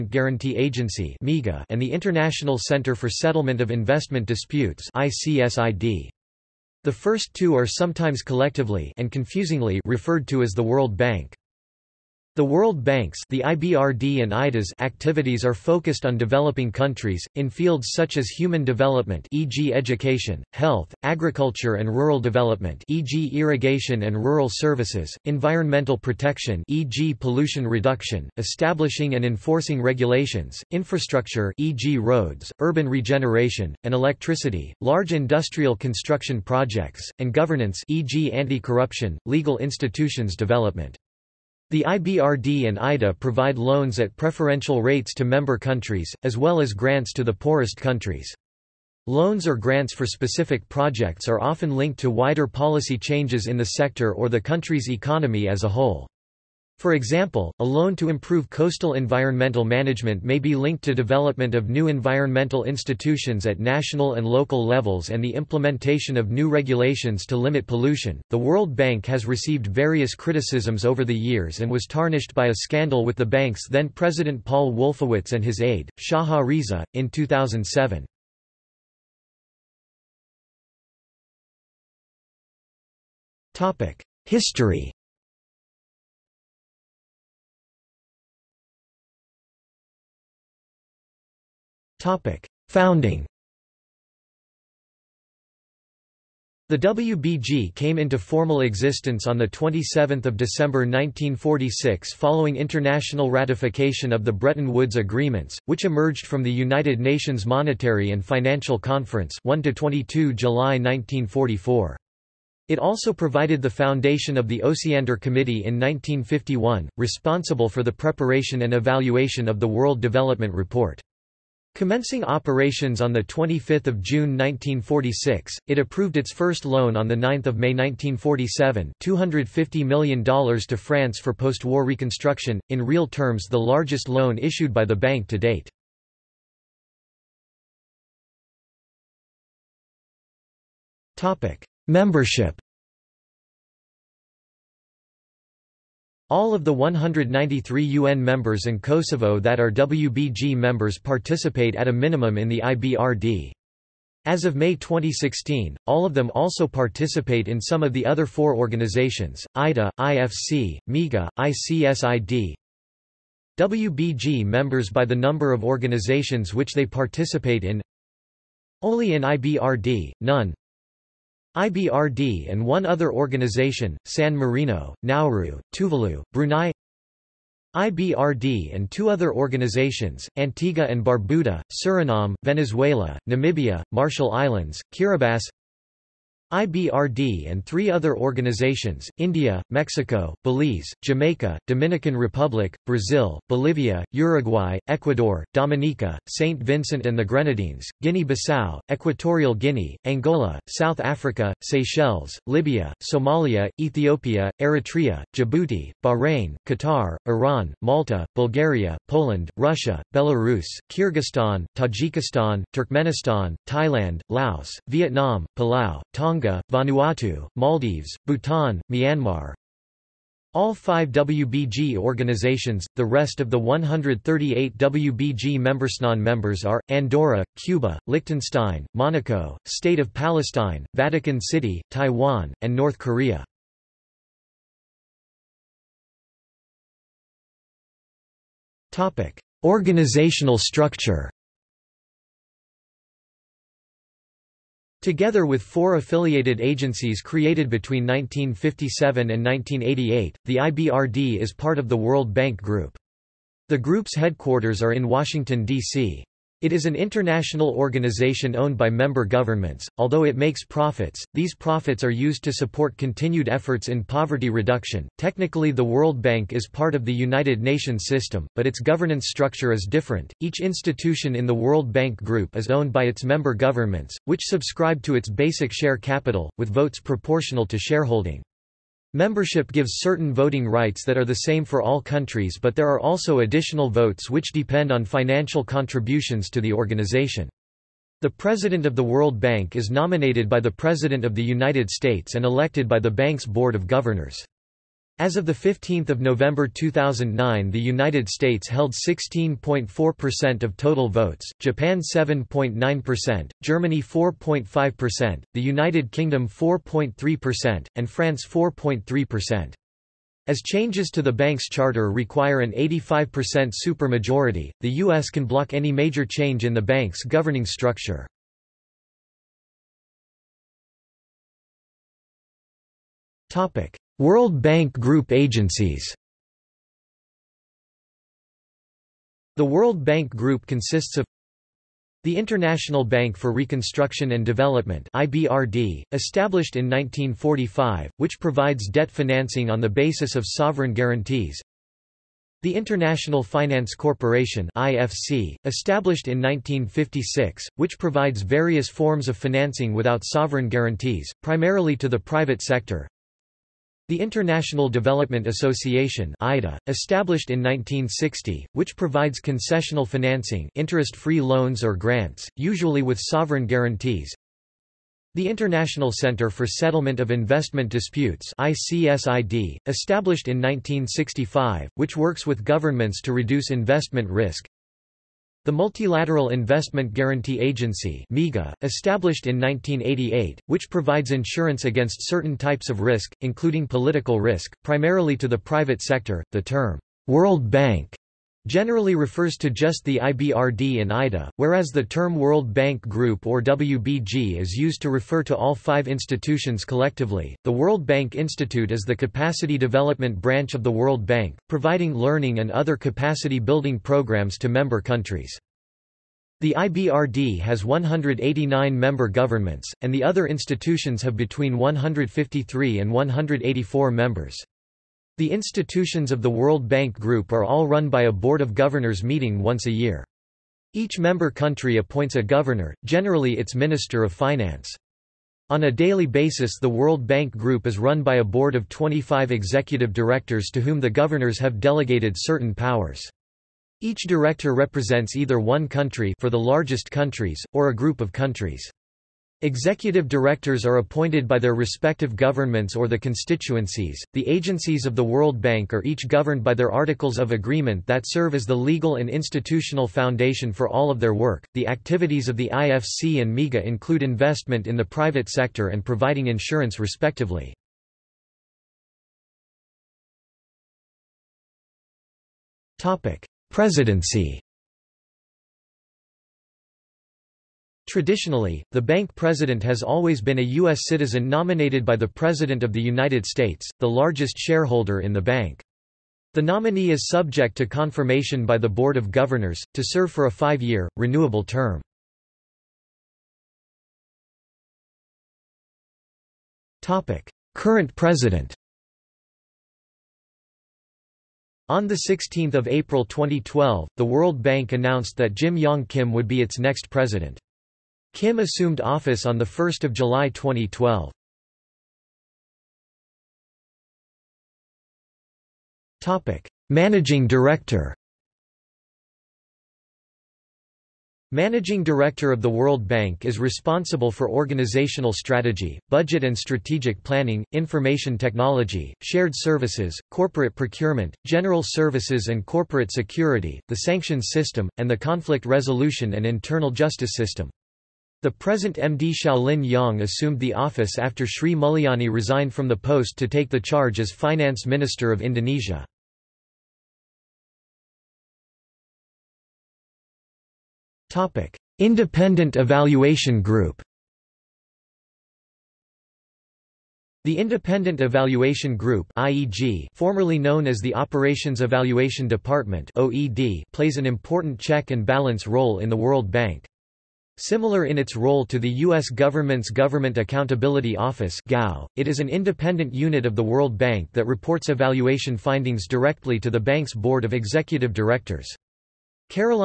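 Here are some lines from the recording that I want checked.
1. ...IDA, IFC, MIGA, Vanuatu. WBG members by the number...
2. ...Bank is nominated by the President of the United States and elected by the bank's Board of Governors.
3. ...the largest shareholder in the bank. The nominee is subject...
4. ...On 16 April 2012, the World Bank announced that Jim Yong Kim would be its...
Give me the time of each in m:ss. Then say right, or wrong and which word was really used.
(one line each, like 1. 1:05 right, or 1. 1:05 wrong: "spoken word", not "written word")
1. 2:39 wrong: "ICSID", not "Vanuatu"
2. 4:49 right
3. 7:53 right
4. 8:11 right.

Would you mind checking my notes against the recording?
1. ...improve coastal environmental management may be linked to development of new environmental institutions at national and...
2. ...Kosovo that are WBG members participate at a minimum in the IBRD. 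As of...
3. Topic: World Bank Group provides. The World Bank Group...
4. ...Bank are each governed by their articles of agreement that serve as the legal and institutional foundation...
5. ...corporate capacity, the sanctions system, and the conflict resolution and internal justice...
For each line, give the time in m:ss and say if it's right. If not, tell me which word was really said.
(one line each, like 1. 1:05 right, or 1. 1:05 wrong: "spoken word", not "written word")
1. 0:58 right
2. 2:28 right
3. 5:23 wrong: "agencies", not "provides"
4. 7:25 right
5. 8:42 wrong: "security", not "capacity".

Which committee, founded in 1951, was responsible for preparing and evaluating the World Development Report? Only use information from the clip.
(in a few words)
Osiander Committee.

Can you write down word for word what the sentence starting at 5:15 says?
can block any major change in the bank's governing structure.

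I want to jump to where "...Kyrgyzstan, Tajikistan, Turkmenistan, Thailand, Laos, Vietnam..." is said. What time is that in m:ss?
3:30.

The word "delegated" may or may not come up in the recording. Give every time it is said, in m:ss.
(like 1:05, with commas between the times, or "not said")
7:11.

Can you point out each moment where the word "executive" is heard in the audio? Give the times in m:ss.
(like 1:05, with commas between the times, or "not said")
7:09, 7:19, 9:27.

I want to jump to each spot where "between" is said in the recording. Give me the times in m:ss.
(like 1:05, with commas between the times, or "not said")
4:07, 6:51.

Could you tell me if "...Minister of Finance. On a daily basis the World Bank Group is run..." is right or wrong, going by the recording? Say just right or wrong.
right.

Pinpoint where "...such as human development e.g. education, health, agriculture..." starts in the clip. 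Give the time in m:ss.
0:17.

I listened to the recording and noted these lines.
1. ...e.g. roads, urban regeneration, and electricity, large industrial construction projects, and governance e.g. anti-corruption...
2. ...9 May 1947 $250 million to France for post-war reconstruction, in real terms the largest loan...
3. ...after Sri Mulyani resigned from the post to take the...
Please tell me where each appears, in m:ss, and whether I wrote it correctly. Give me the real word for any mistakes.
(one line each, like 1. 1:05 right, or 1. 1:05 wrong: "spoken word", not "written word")
1. 0:31 right
2. 2:07 right
3. 8:51 right.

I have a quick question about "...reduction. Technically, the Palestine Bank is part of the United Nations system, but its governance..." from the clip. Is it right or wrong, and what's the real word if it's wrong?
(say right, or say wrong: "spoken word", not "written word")
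wrong: "World", not "Palestine".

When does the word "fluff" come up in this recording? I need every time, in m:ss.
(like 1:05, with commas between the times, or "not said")
not said.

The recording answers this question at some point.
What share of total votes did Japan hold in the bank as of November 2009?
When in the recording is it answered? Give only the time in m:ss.
5:01.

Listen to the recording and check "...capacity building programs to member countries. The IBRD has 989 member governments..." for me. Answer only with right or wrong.
wrong.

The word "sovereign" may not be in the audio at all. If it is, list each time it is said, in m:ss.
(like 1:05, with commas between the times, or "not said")
5:40, 5:50, 6:03.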